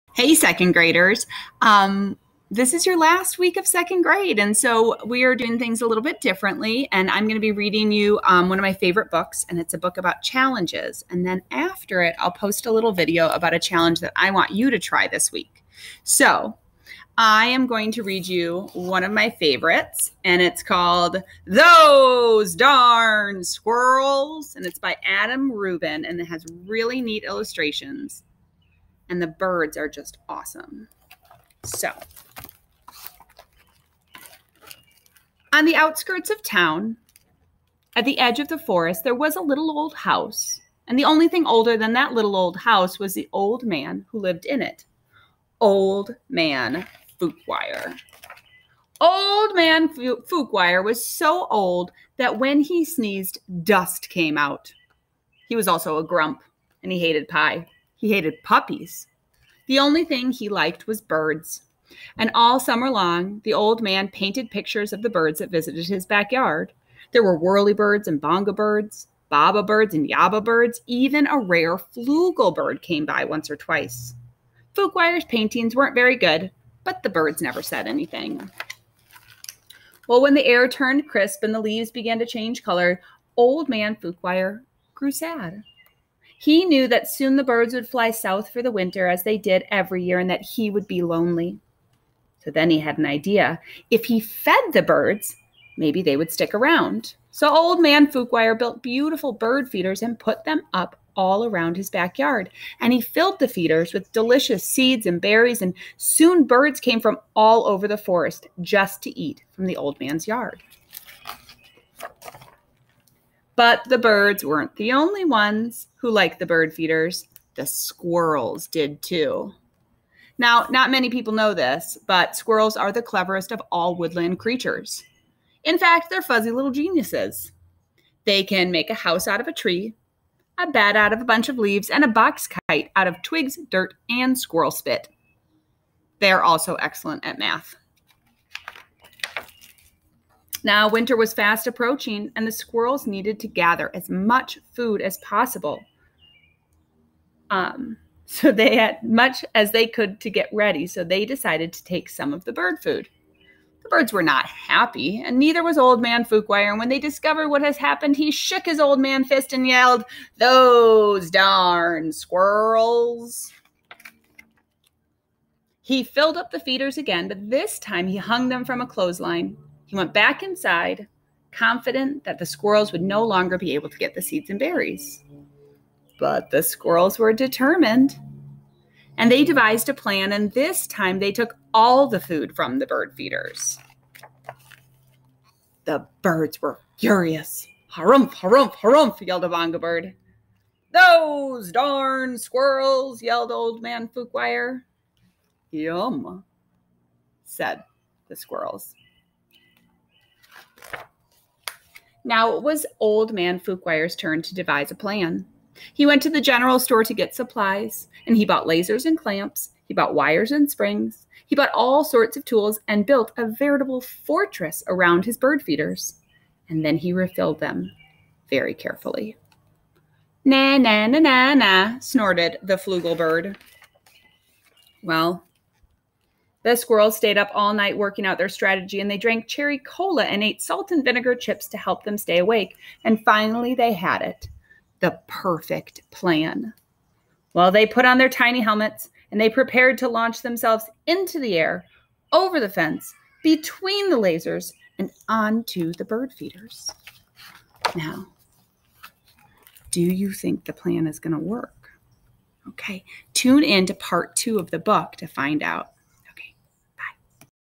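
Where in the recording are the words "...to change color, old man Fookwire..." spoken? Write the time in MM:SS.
01:22.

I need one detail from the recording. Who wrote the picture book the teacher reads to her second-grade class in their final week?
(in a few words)
Adam Rubin.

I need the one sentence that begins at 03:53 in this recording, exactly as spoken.
And finally, they had it the perfect plan.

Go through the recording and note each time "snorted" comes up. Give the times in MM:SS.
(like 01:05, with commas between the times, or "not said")
03:41.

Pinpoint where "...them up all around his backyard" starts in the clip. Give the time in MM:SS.
01:40.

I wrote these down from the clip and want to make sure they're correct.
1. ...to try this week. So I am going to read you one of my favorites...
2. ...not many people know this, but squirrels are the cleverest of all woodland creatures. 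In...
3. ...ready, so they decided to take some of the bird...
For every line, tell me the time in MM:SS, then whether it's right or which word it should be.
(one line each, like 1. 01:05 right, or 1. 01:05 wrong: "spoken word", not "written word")
1. 00:14 right
2. 02:00 right
3. 02:30 right.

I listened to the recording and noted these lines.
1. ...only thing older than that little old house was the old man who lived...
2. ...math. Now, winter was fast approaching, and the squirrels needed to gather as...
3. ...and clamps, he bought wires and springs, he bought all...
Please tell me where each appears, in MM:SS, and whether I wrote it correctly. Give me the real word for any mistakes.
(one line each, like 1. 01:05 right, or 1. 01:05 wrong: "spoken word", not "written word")
1. 00:41 right
2. 02:17 right
3. 03:29 right.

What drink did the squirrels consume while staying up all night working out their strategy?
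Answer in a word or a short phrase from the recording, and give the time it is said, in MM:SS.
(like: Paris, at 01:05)
cherry cola, at 03:49.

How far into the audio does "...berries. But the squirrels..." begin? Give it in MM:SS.
02:54.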